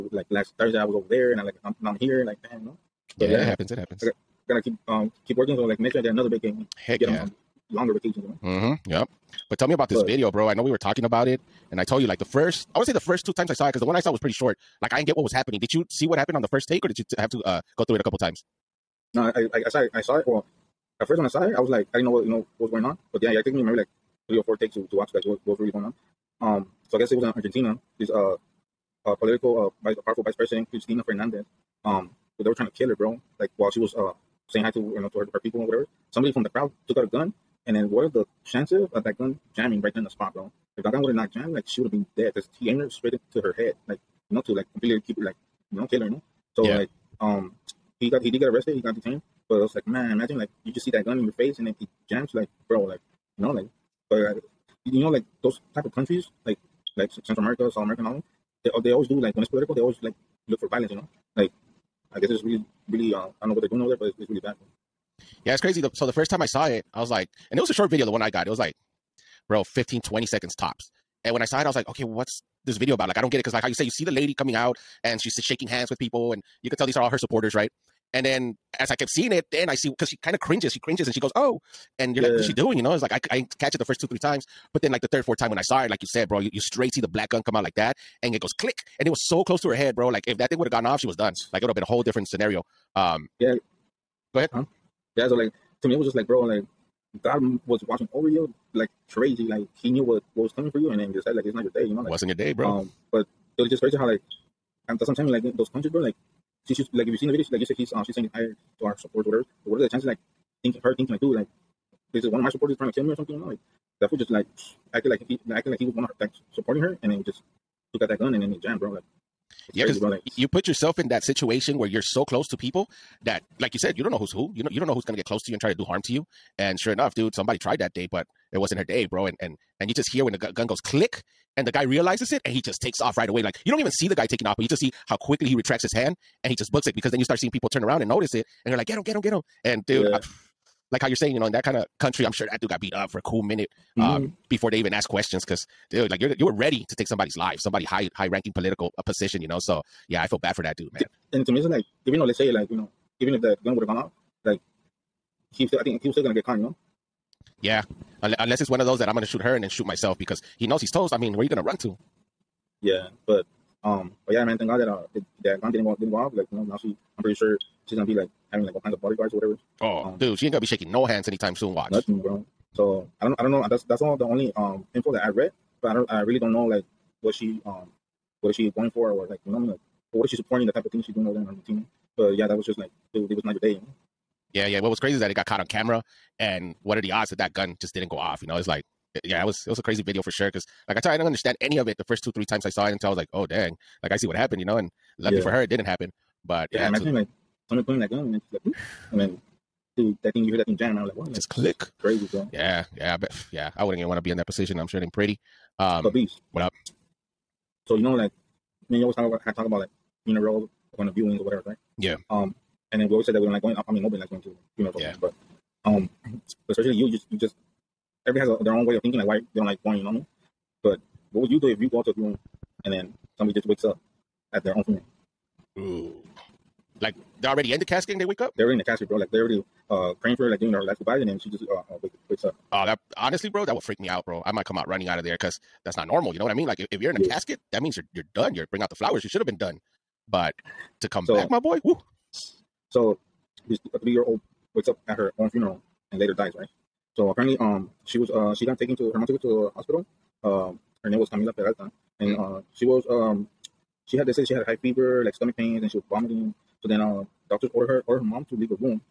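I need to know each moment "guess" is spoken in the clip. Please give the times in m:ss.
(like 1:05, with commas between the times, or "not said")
0:26, 1:02.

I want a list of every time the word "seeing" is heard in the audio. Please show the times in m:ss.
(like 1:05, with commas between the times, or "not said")
1:19, 2:17.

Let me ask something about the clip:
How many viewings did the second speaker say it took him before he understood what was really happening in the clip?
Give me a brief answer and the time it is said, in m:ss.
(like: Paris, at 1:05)
3 or 4, at 0:24.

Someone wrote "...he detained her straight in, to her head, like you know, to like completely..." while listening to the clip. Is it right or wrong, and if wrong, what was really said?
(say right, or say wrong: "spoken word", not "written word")
wrong: "aimed", not "detained".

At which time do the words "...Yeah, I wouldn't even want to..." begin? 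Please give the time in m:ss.
3:23.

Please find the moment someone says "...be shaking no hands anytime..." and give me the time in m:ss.
2:50.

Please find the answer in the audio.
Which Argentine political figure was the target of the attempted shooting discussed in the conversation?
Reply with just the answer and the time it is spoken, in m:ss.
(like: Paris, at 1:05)
Cristina Fernandez, at 0:30.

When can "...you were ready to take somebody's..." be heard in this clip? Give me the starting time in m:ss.
2:26.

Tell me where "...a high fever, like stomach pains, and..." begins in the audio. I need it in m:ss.
4:14.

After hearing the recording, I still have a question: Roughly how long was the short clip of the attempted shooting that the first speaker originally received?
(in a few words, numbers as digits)
15 to 20 seconds.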